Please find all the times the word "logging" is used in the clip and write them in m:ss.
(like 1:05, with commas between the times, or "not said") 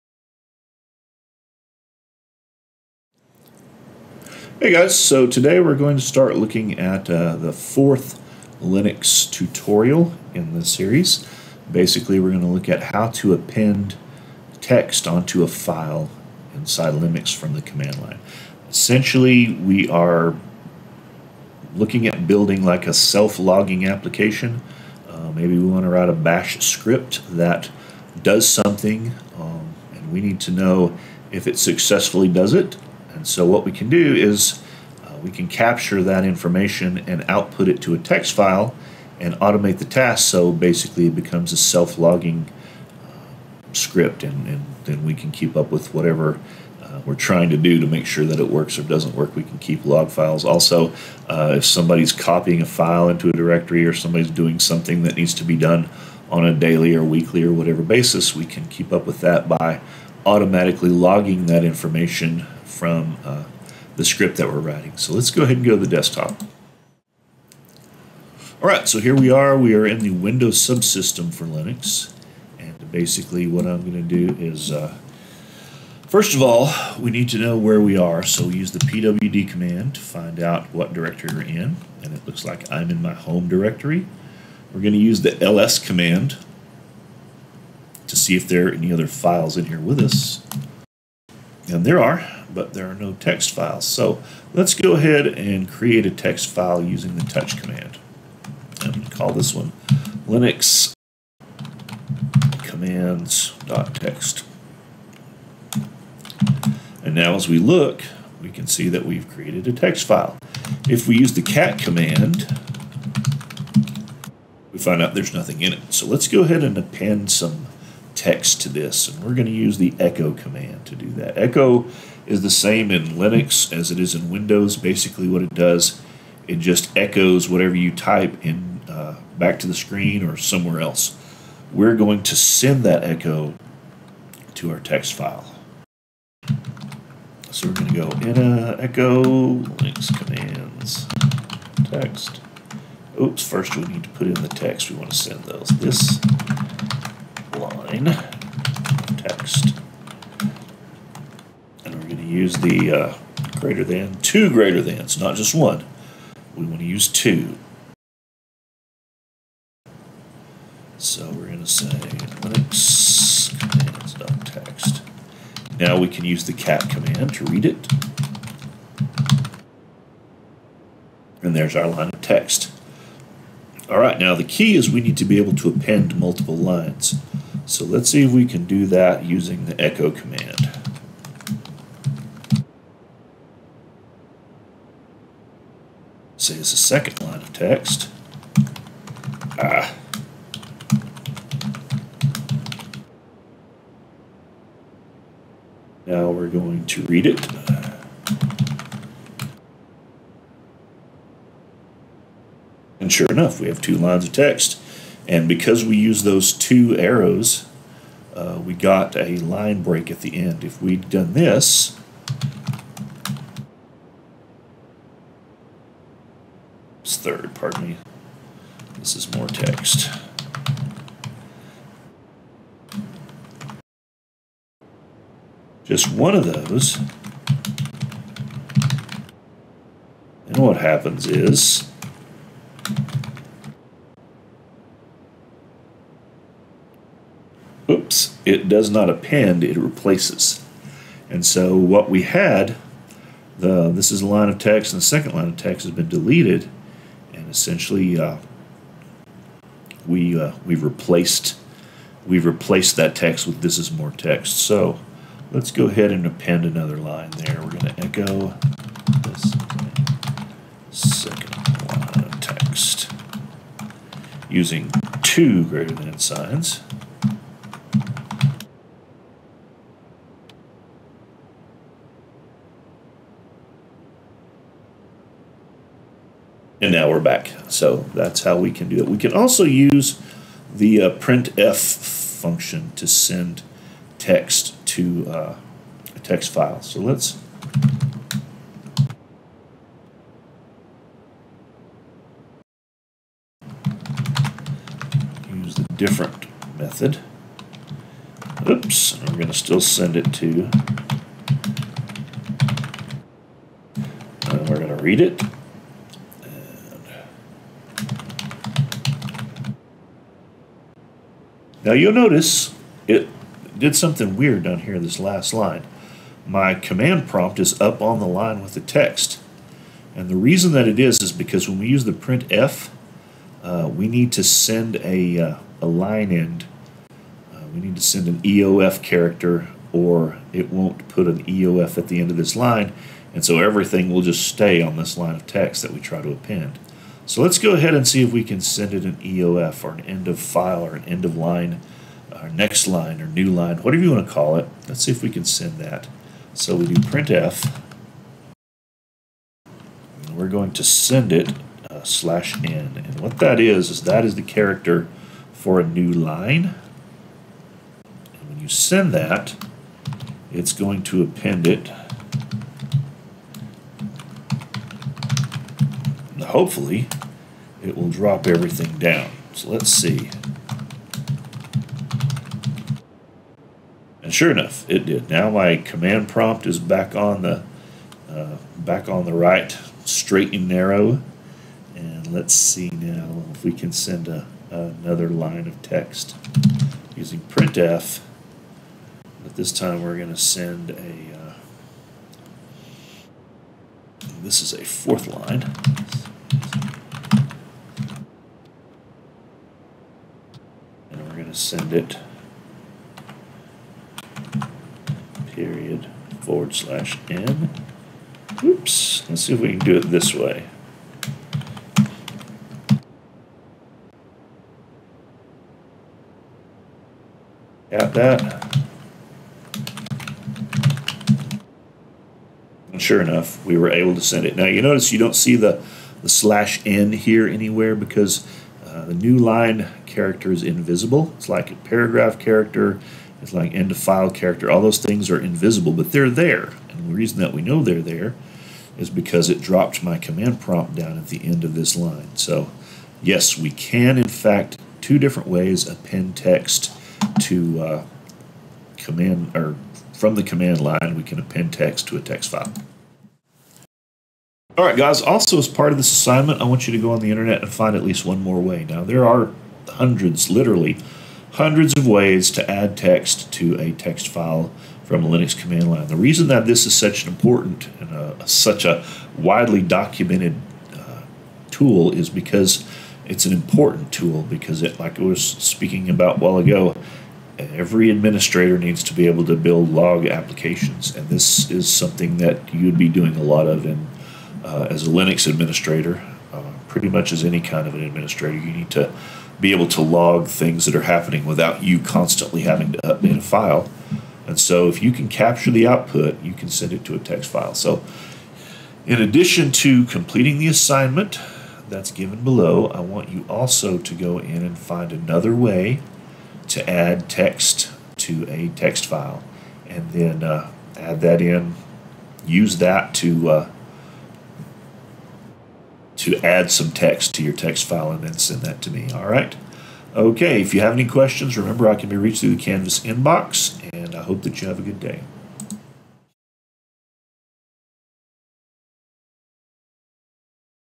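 0:22, 0:41, 1:00.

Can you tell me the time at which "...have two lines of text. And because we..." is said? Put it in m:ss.
3:23.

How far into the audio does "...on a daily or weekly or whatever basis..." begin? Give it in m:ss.
0:56.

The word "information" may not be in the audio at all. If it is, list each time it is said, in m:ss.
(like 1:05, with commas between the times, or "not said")
0:36, 1:01.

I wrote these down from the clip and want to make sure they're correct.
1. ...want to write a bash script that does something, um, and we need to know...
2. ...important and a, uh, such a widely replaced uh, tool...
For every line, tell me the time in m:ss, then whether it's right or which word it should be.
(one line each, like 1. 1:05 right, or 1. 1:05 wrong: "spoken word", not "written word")
1. 0:25 right
2. 7:47 wrong: "documented", not "replaced".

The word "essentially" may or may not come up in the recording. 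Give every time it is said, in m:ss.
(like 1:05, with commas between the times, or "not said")
0:18, 4:07.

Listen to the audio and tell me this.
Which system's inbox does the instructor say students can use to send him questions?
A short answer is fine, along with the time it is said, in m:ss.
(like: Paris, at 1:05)
Canvas, at 8:42.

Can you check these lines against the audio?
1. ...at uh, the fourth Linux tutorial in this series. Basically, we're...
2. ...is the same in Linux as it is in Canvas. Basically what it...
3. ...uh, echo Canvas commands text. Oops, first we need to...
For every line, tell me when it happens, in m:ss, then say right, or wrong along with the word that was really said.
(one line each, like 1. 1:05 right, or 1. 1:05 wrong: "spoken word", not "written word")
1. 0:06 right
2. 2:02 wrong: "Windows", not "Canvas"
3. 2:18 wrong: "Linux", not "Canvas".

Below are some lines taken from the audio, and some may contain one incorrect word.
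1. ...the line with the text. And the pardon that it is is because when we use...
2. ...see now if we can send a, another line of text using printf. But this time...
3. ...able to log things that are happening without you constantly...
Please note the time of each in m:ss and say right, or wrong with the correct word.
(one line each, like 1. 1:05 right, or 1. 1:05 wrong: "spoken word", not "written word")
1. 5:18 wrong: "reason", not "pardon"
2. 6:22 right
3. 8:09 right.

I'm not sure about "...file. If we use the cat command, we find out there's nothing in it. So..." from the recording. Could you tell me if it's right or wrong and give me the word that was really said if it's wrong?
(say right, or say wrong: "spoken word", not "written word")
right.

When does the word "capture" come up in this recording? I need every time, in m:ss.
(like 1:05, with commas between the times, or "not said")
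0:35, 8:15.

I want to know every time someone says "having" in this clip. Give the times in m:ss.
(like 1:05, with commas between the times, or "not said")
8:12.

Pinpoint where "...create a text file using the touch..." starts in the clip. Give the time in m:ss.
1:35.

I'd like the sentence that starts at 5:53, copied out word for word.
And what that is, is that is the character for a new line.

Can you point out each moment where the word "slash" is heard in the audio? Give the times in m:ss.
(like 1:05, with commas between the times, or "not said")
5:52, 6:46, 7:06.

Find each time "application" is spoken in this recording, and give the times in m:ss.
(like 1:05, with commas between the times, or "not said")
0:23, 8:00.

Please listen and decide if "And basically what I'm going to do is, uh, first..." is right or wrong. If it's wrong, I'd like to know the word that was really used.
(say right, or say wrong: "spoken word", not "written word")
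right.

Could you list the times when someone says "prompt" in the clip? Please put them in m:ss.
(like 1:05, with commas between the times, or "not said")
5:17, 6:16, 7:20.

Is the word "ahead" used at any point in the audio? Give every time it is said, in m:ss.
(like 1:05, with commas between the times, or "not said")
1:05, 1:34, 1:56, 4:15, 5:37.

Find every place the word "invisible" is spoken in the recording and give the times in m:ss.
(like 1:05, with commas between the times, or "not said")
7:10, 7:15.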